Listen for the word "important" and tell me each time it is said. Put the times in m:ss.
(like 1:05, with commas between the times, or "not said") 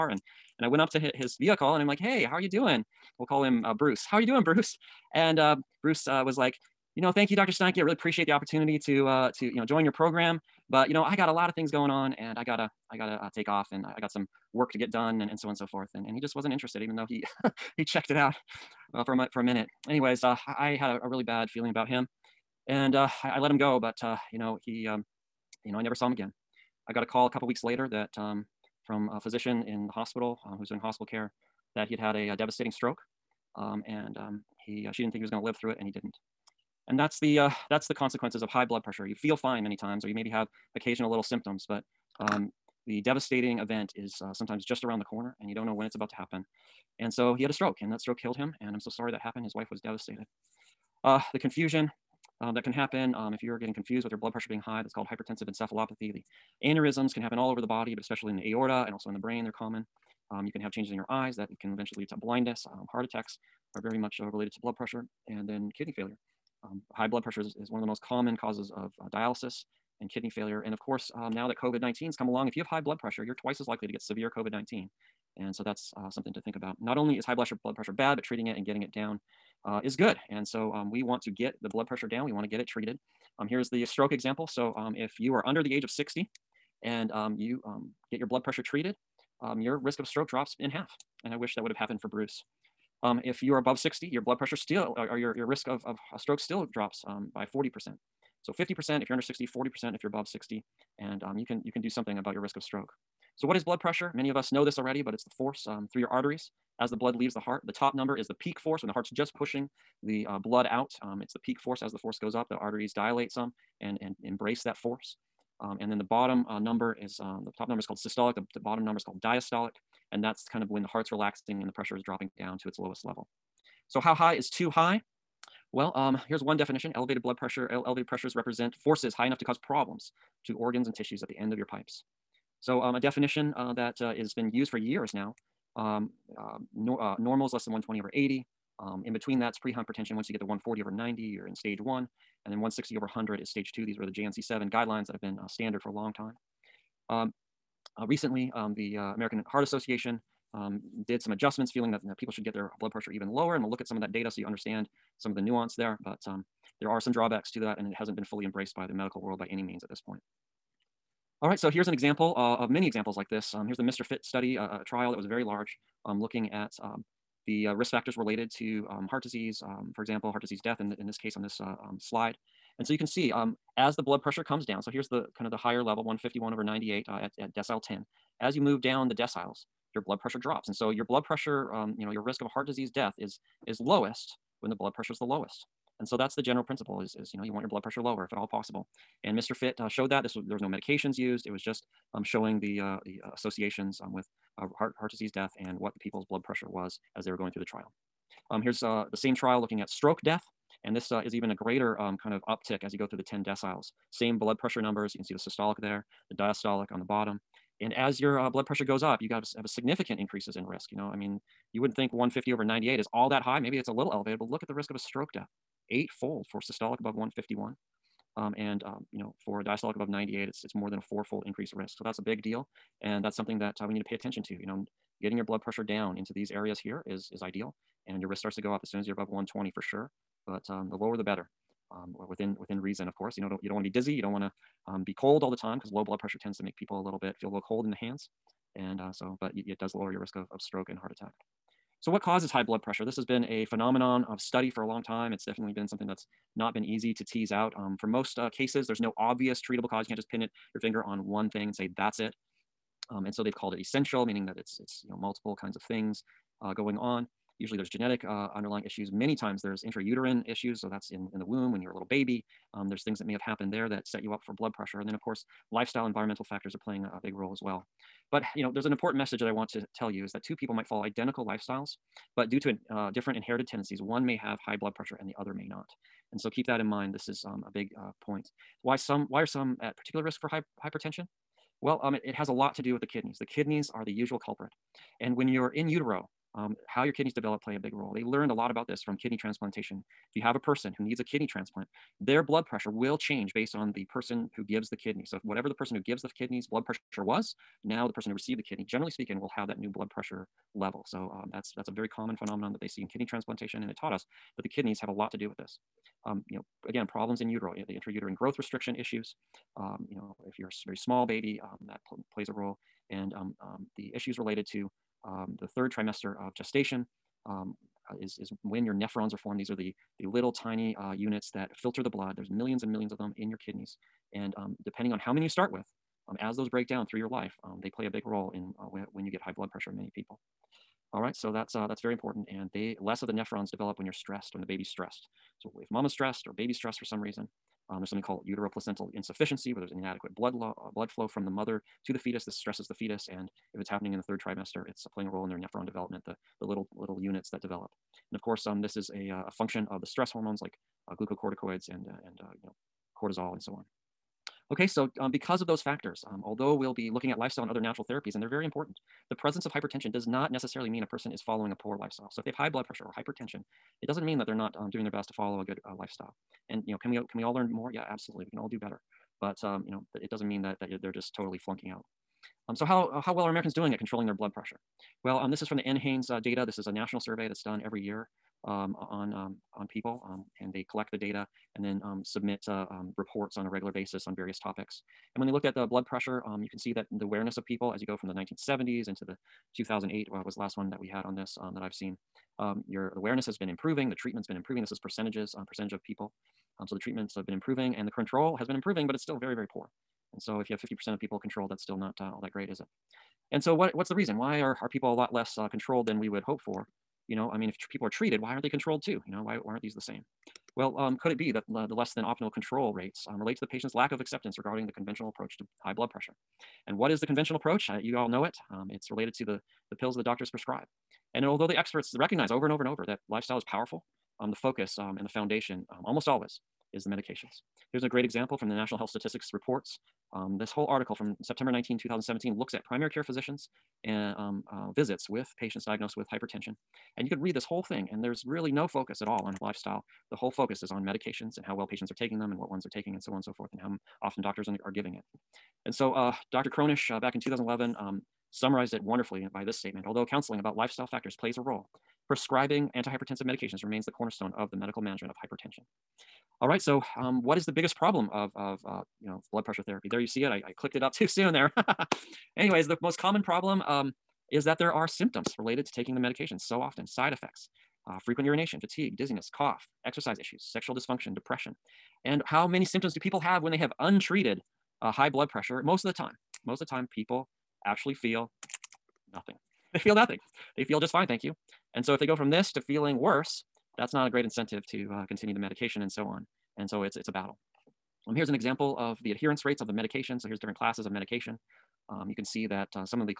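4:28, 5:32, 5:58.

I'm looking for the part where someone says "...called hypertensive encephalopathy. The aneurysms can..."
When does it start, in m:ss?
0:54.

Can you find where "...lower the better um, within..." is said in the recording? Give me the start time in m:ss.
3:50.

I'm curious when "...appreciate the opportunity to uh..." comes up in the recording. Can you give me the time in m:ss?
0:07.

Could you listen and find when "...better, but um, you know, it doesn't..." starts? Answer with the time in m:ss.
6:08.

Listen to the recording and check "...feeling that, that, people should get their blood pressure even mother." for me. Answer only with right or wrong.
wrong.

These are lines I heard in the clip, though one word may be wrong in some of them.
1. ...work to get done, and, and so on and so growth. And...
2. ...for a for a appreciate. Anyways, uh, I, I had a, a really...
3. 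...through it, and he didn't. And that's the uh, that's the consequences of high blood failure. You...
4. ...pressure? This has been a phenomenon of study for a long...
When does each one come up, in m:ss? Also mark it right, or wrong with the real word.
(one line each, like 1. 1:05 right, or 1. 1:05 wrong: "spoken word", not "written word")
1. 0:14 wrong: "forth", not "growth"
2. 0:19 wrong: "minute", not "appreciate"
3. 0:35 wrong: "pressure", not "failure"
4. 4:02 right.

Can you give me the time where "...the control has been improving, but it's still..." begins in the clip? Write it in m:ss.
6:38.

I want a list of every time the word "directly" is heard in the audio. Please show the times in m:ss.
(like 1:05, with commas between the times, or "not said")
not said.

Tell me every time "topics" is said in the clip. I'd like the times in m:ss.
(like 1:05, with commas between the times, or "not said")
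6:24.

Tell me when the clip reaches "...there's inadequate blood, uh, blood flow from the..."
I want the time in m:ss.
5:39.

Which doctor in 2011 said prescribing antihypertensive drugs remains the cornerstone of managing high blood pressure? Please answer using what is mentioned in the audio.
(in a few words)
Dr. Kronish.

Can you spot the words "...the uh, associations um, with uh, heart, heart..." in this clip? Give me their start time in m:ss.
3:13.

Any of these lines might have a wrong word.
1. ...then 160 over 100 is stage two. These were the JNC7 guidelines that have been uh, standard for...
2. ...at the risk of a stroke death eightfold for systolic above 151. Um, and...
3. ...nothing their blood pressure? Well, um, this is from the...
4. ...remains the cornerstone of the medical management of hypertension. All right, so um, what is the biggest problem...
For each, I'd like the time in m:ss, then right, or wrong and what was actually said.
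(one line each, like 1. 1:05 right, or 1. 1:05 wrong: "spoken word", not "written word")
1. 2:22 right
2. 3:34 right
3. 6:13 wrong: "controlling", not "nothing"
4. 7:33 right.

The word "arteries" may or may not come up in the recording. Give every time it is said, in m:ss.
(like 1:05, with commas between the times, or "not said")
1:46, 1:52.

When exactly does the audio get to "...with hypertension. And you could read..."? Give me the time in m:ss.
7:16.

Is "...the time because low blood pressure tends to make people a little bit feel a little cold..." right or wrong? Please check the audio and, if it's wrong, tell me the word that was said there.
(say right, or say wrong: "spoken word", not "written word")
right.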